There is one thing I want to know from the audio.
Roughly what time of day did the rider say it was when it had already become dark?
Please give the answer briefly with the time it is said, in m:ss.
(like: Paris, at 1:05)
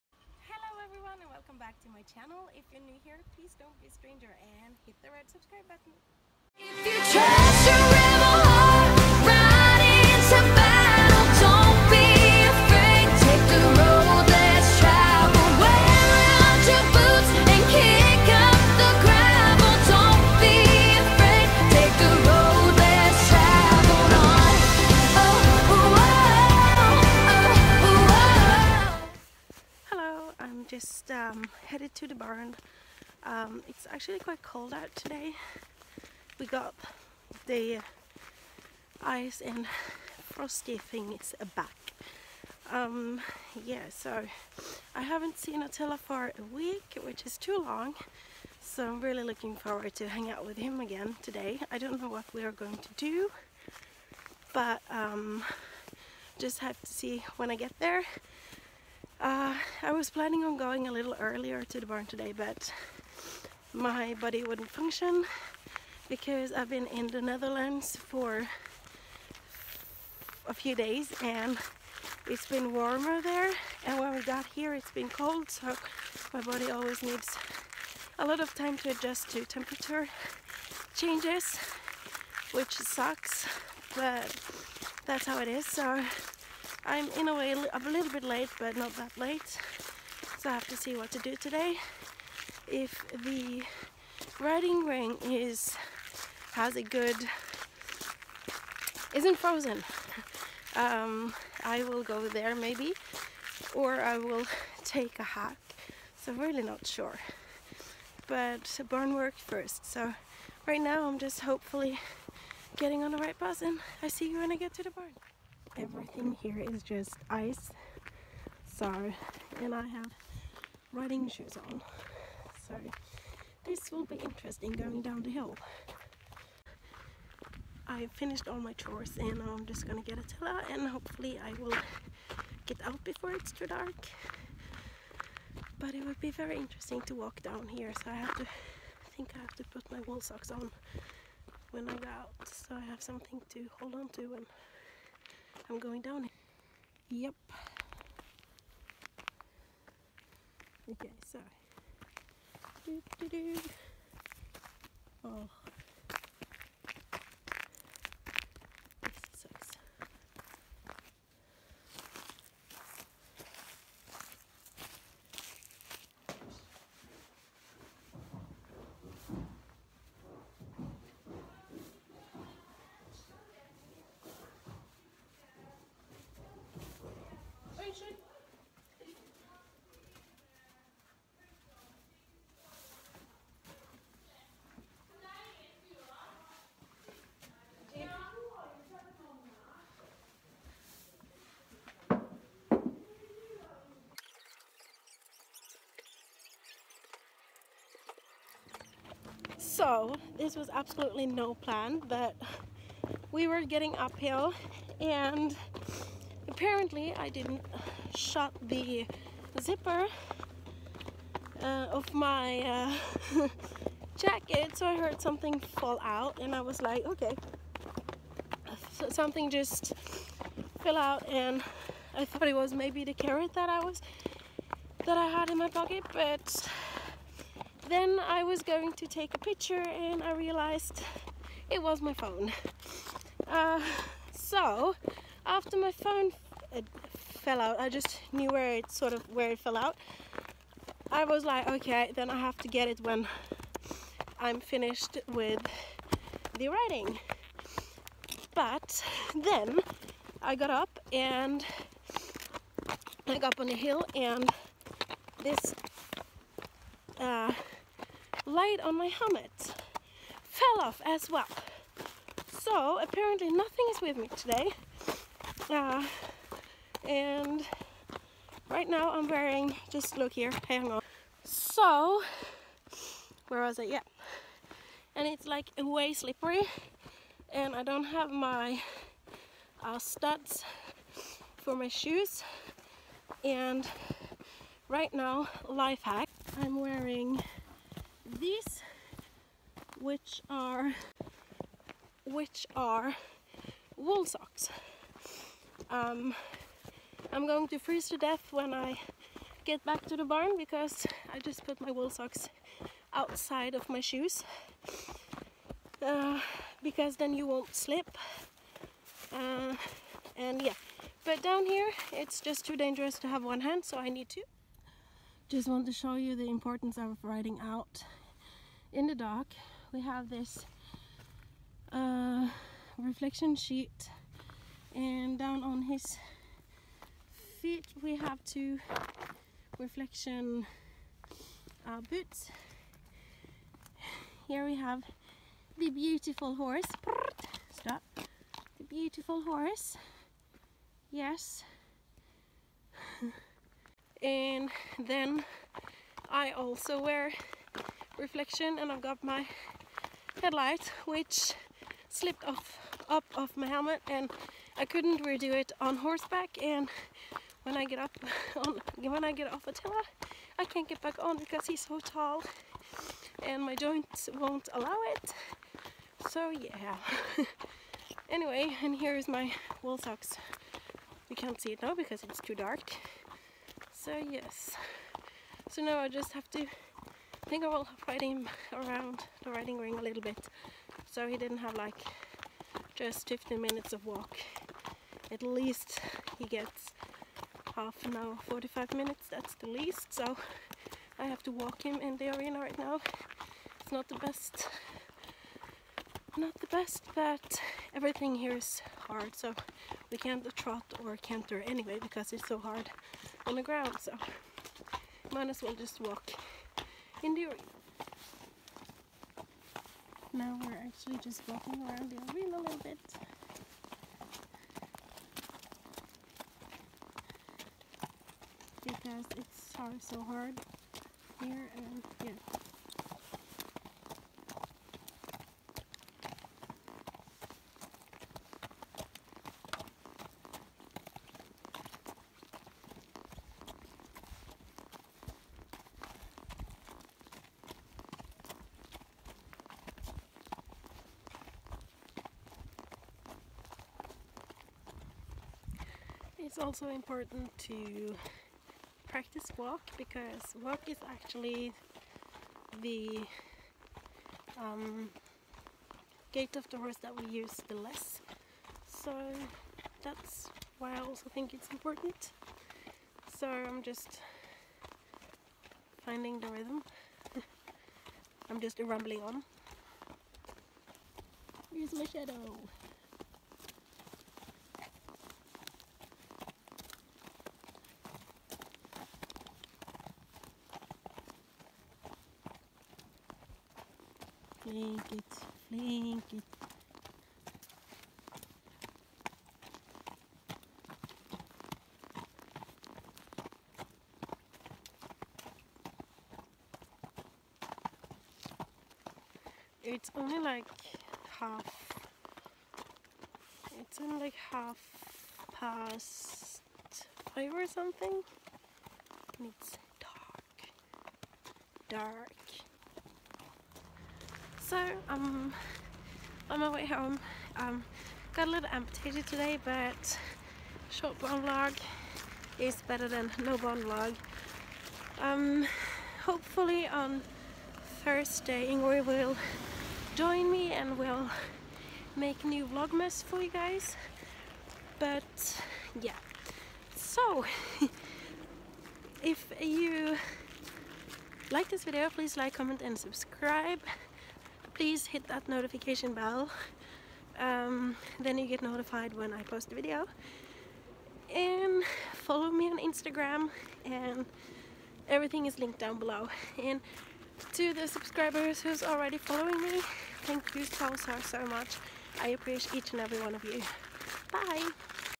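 Half past five, at 8:24.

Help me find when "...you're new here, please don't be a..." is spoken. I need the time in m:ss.
0:02.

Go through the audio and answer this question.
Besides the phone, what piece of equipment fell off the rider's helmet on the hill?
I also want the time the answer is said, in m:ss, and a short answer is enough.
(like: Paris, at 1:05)
Light, at 4:18.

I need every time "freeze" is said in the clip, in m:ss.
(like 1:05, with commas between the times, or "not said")
4:57.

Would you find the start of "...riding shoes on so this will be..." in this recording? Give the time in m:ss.
2:00.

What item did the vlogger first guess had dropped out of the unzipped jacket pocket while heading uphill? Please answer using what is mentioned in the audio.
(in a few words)
Carrot.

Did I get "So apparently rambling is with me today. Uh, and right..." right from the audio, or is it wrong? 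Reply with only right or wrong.
wrong.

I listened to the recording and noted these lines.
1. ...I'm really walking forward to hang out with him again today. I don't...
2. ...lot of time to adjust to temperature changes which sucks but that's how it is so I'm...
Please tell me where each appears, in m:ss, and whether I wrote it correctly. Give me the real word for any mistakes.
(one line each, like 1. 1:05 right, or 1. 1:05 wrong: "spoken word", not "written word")
1. 0:48 wrong: "looking", not "walking"
2. 1:18 right.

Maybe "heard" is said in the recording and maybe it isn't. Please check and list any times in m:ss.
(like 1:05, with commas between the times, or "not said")
3:34.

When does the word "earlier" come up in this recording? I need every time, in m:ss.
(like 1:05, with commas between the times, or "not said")
1:01.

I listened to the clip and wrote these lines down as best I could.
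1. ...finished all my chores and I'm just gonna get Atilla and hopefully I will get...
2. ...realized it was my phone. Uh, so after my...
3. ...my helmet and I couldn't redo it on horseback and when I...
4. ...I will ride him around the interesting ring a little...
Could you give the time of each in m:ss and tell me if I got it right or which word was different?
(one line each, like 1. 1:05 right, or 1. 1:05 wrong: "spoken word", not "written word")
1. 2:08 right
2. 3:50 right
3. 5:53 right
4. 6:17 wrong: "riding", not "interesting".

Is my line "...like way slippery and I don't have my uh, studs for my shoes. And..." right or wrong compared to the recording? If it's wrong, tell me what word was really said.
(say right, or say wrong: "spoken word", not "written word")
right.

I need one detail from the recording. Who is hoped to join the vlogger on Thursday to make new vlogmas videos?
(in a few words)
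Ingrid.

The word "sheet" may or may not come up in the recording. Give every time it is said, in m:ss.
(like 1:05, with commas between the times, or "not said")
5:23.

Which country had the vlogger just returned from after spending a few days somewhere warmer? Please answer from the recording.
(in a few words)
The Netherlands.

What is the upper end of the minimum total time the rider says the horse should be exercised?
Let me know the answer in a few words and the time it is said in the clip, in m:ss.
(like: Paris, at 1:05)
45 minutes, at 6:28.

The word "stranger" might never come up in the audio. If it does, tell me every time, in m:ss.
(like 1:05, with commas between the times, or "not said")
0:03.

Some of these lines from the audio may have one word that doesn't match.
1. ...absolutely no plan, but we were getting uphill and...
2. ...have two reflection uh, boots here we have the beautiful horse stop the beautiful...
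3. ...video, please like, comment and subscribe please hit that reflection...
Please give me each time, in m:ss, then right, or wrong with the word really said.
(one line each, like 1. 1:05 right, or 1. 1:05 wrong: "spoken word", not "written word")
1. 3:20 right
2. 5:28 right
3. 9:01 wrong: "notification", not "reflection".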